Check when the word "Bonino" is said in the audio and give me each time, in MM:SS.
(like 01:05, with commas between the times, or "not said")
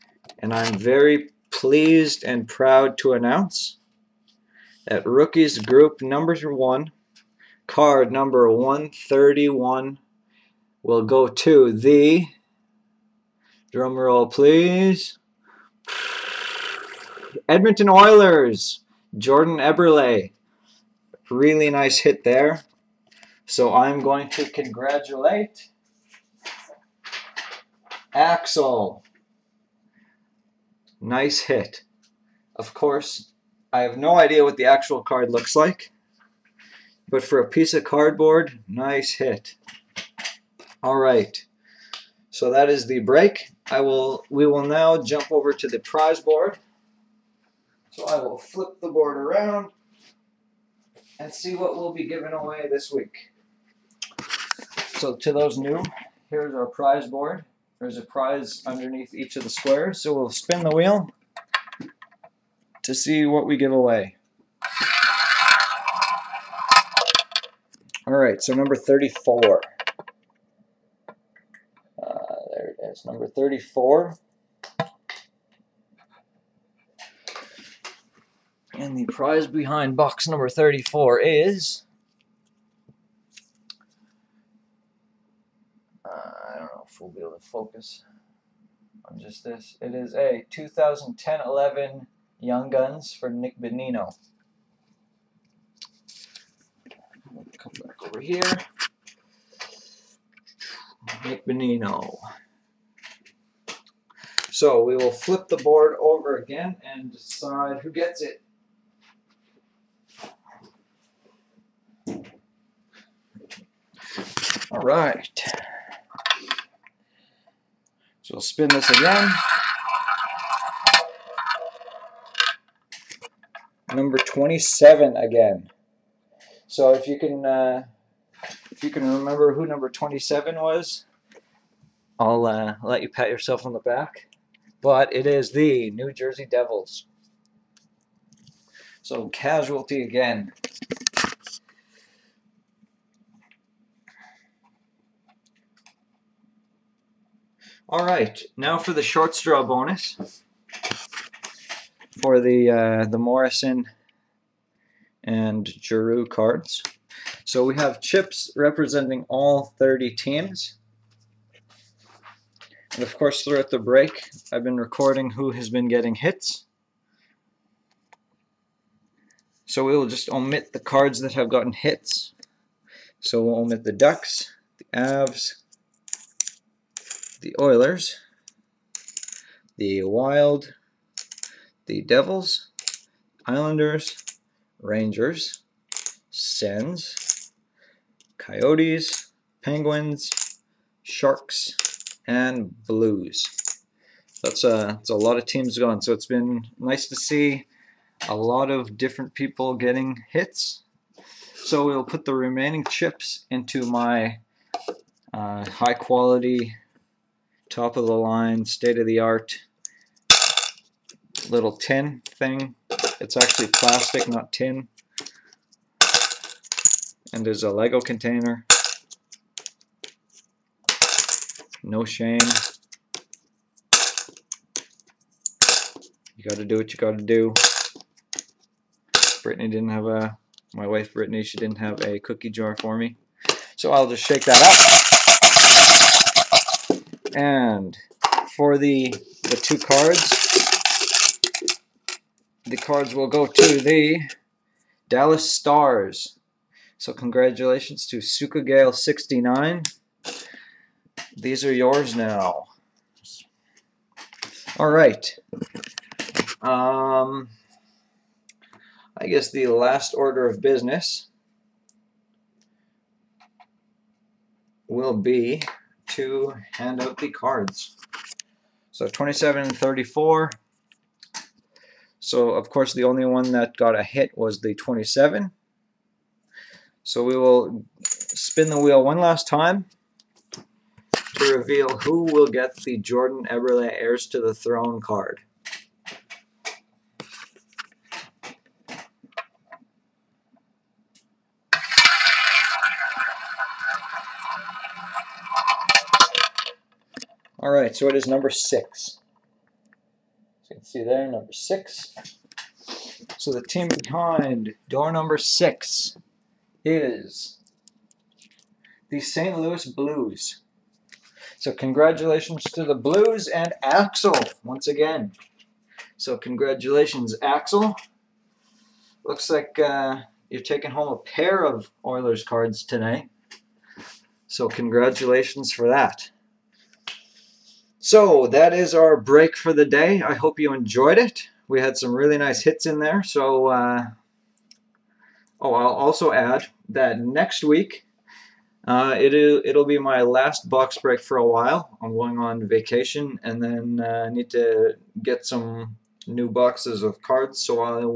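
01:33, 01:41.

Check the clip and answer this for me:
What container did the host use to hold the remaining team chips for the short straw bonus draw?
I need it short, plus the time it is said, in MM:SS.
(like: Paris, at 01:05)
Lego container, at 03:37.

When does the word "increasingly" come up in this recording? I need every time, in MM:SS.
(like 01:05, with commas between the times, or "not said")
not said.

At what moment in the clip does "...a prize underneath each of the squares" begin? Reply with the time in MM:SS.
00:57.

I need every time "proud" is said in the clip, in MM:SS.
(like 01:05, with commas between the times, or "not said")
00:02.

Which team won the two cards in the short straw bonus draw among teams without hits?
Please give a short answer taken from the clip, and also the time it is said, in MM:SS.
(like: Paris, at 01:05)
Dallas Stars, at 04:05.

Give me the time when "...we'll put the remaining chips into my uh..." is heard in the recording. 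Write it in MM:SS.
03:21.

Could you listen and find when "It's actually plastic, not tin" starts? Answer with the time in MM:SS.
03:33.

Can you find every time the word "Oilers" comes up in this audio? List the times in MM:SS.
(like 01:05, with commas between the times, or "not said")
00:17, 02:57, 05:22.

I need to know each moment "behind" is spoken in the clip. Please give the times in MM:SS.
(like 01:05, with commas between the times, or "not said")
01:19, 05:04.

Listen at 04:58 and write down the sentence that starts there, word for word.
right, so it is number six.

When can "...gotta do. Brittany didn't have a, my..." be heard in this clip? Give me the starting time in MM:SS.
03:46.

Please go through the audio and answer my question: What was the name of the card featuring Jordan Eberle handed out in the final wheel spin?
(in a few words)
Heirs to the Throne.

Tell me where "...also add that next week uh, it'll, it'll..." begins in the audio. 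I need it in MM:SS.
05:35.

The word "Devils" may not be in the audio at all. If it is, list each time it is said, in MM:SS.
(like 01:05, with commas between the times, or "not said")
02:16, 03:02.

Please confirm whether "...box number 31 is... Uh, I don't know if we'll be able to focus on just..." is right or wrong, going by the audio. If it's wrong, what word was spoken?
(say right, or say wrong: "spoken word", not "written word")
wrong: "34", not "31".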